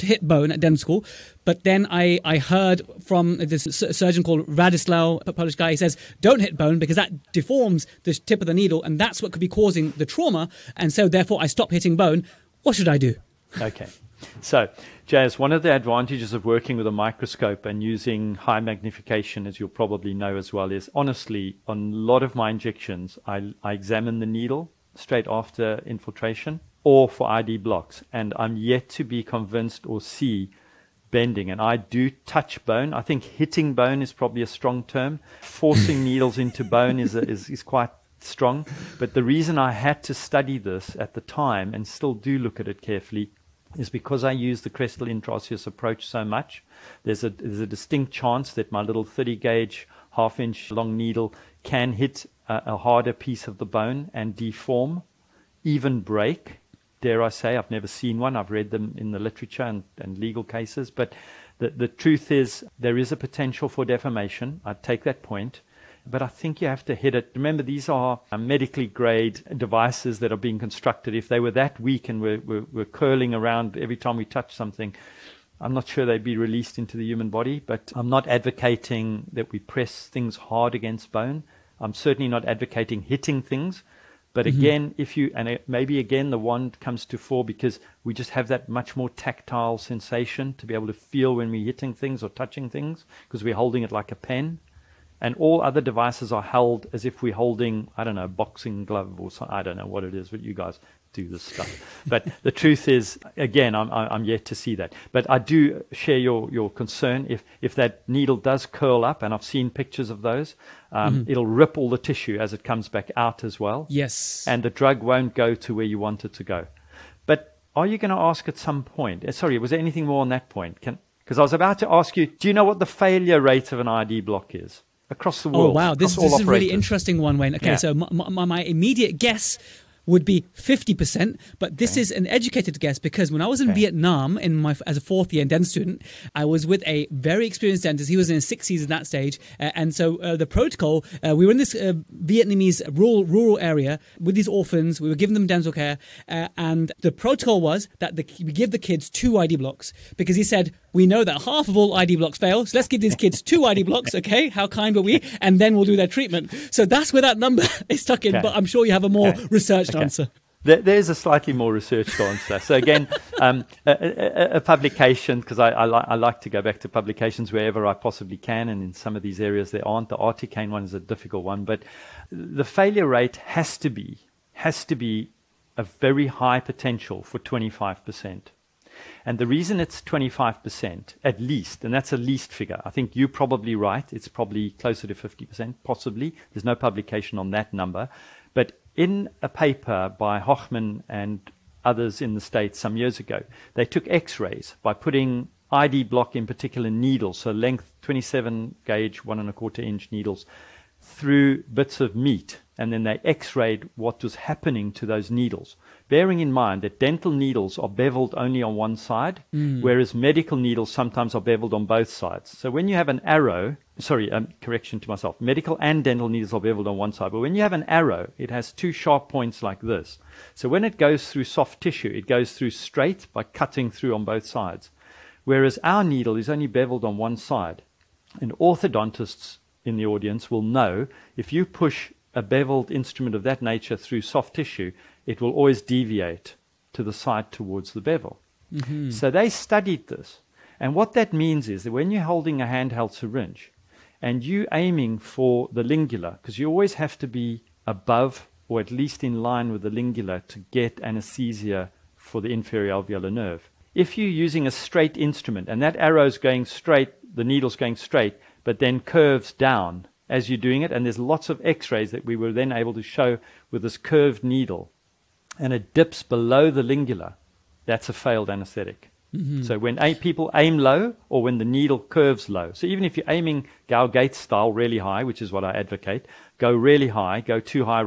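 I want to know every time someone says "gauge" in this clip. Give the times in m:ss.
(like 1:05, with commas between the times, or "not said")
0:49, 3:18.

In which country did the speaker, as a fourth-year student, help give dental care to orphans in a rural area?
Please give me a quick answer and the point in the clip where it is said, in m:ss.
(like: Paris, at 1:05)
Vietnam, at 2:13.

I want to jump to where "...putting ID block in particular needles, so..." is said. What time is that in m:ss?
3:14.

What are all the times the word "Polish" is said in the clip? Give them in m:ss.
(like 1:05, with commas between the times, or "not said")
0:05.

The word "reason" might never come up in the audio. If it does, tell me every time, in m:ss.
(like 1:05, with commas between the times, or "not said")
0:39, 2:59.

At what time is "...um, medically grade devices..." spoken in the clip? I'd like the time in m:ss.
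1:08.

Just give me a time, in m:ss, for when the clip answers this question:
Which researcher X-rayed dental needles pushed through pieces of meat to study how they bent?
3:10.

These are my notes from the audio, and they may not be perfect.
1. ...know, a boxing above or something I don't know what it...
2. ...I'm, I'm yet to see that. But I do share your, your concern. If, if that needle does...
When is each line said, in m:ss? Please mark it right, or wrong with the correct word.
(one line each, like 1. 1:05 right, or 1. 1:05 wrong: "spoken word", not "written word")
1. 1:38 wrong: "glove", not "above"
2. 1:43 right.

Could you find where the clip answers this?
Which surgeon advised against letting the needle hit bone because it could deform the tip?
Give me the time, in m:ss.
0:04.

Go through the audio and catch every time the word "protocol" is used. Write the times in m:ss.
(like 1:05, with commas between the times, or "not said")
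2:20, 2:27.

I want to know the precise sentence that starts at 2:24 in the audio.
We were giving them dental care.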